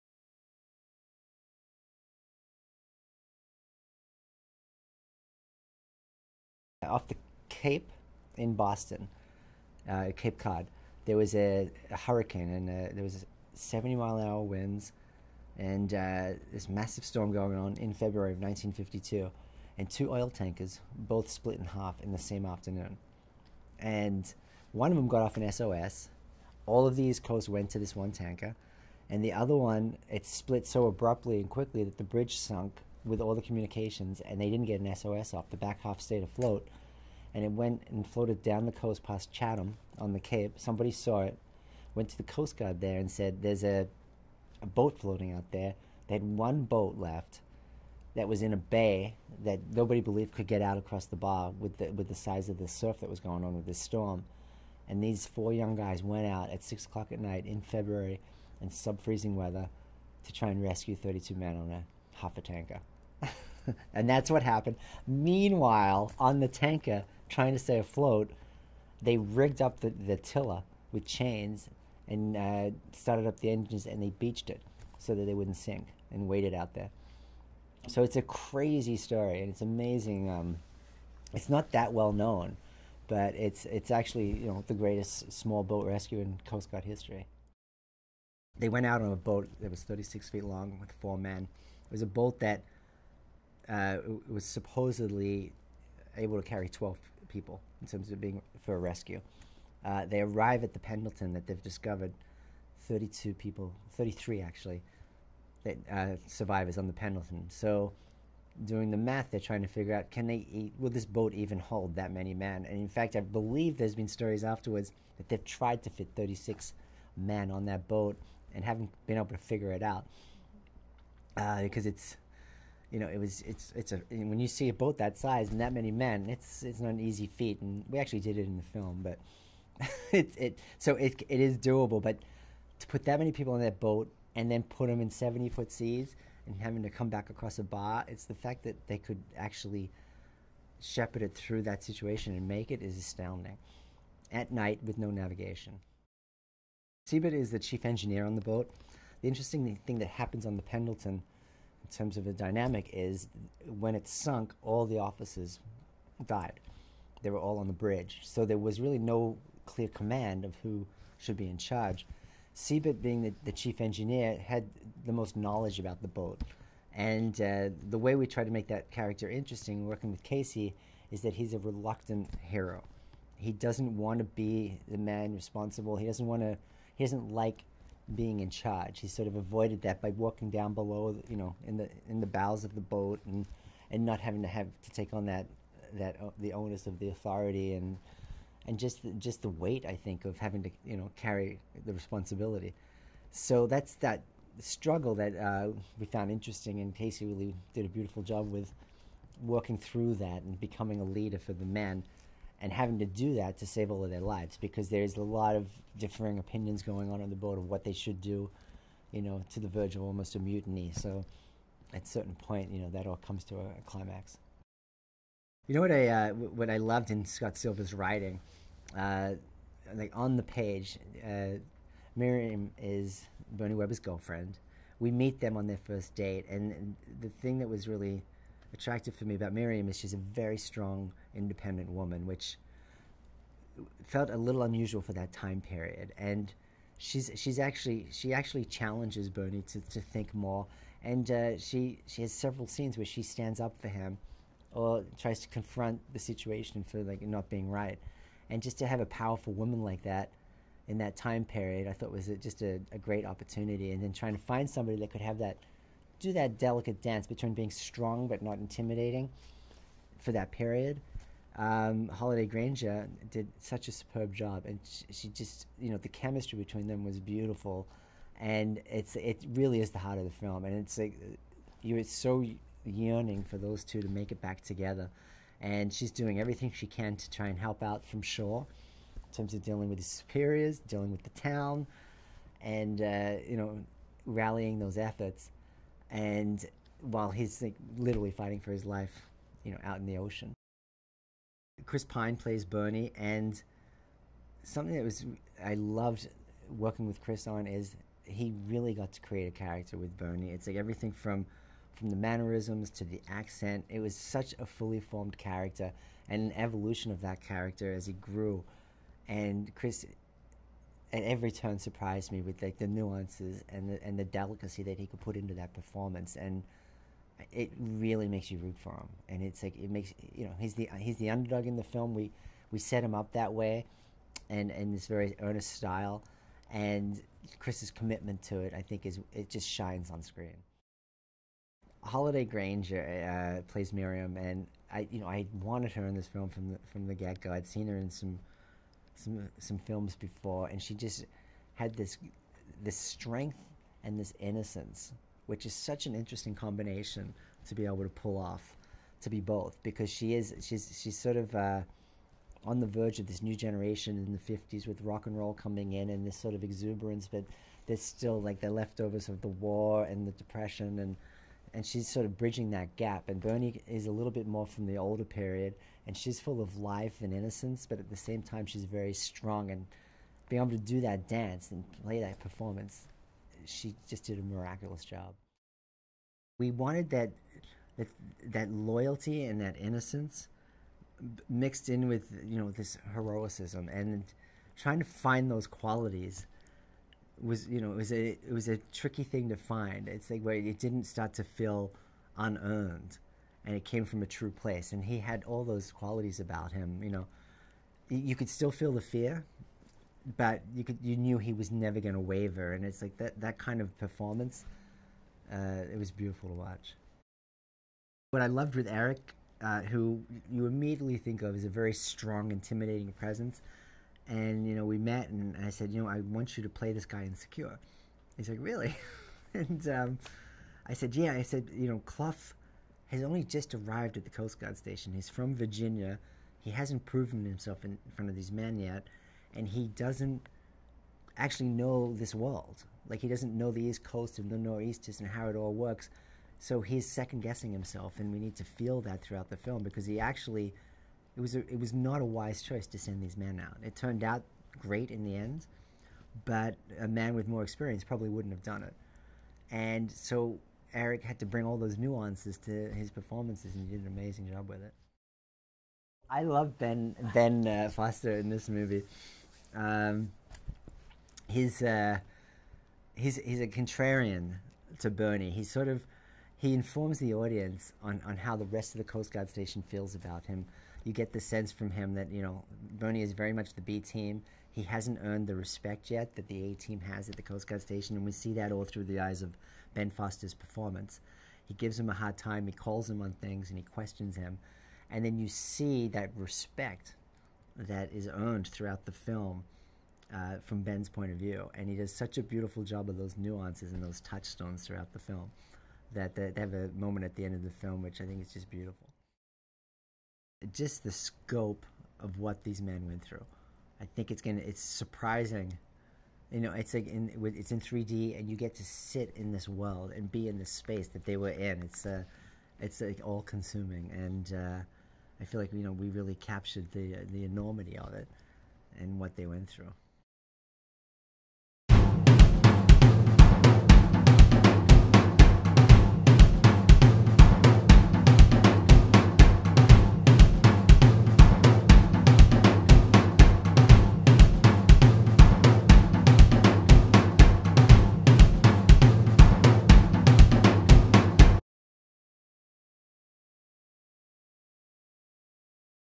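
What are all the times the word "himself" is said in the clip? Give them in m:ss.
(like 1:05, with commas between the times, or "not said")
7:07, 7:17.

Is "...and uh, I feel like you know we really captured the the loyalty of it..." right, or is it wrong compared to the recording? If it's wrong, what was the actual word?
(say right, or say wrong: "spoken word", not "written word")
wrong: "enormity", not "loyalty".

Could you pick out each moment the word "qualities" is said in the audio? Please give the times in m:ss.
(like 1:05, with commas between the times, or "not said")
6:25, 6:35.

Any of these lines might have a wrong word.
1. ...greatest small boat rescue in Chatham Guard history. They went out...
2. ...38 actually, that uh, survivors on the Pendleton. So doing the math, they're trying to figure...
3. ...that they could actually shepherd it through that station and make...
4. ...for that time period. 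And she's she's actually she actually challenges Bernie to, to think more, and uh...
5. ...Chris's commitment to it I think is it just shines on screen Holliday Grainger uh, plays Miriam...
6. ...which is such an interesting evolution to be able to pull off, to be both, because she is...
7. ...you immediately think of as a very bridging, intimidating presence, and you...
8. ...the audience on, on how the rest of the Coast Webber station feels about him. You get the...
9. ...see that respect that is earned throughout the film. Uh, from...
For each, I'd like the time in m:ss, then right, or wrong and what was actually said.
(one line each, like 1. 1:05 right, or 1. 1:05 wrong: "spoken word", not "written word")
1. 1:24 wrong: "Coast", not "Chatham"
2. 1:43 wrong: "33", not "38"
3. 2:18 wrong: "situation", not "station"
4. 3:55 right
5. 5:27 right
6. 5:45 wrong: "combination", not "evolution"
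7. 6:50 wrong: "strong", not "bridging"
8. 7:47 wrong: "Guard", not "Webber"
9. 8:05 right.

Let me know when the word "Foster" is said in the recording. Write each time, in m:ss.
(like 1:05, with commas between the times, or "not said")
7:37, 8:00.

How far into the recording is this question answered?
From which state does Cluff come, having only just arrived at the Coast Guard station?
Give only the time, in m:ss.
7:05.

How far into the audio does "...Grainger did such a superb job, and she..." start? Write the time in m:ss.
4:22.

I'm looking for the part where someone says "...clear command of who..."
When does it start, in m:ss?
2:39.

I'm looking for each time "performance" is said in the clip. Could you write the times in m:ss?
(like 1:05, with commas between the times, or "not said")
5:15, 6:12, 6:43, 7:33, 8:00.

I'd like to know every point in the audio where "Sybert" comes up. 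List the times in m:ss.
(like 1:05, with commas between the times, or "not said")
2:27, 2:42.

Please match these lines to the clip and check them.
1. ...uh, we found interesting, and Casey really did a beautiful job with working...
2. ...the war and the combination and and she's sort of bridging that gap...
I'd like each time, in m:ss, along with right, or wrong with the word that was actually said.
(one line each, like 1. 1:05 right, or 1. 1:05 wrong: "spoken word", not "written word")
1. 3:15 right
2. 5:59 wrong: "depression", not "combination".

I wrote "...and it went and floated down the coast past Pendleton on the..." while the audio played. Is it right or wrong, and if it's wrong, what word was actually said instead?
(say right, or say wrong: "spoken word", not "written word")
wrong: "Chatham", not "Pendleton".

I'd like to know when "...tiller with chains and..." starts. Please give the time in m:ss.
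1:10.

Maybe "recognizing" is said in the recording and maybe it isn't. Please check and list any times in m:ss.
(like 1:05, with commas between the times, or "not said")
not said.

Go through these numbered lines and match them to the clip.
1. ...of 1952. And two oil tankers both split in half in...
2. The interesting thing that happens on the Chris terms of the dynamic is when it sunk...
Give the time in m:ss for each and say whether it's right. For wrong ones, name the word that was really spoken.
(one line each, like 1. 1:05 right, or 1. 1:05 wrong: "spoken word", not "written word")
1. 0:18 right
2. 2:29 wrong: "Pendleton", not "Chris".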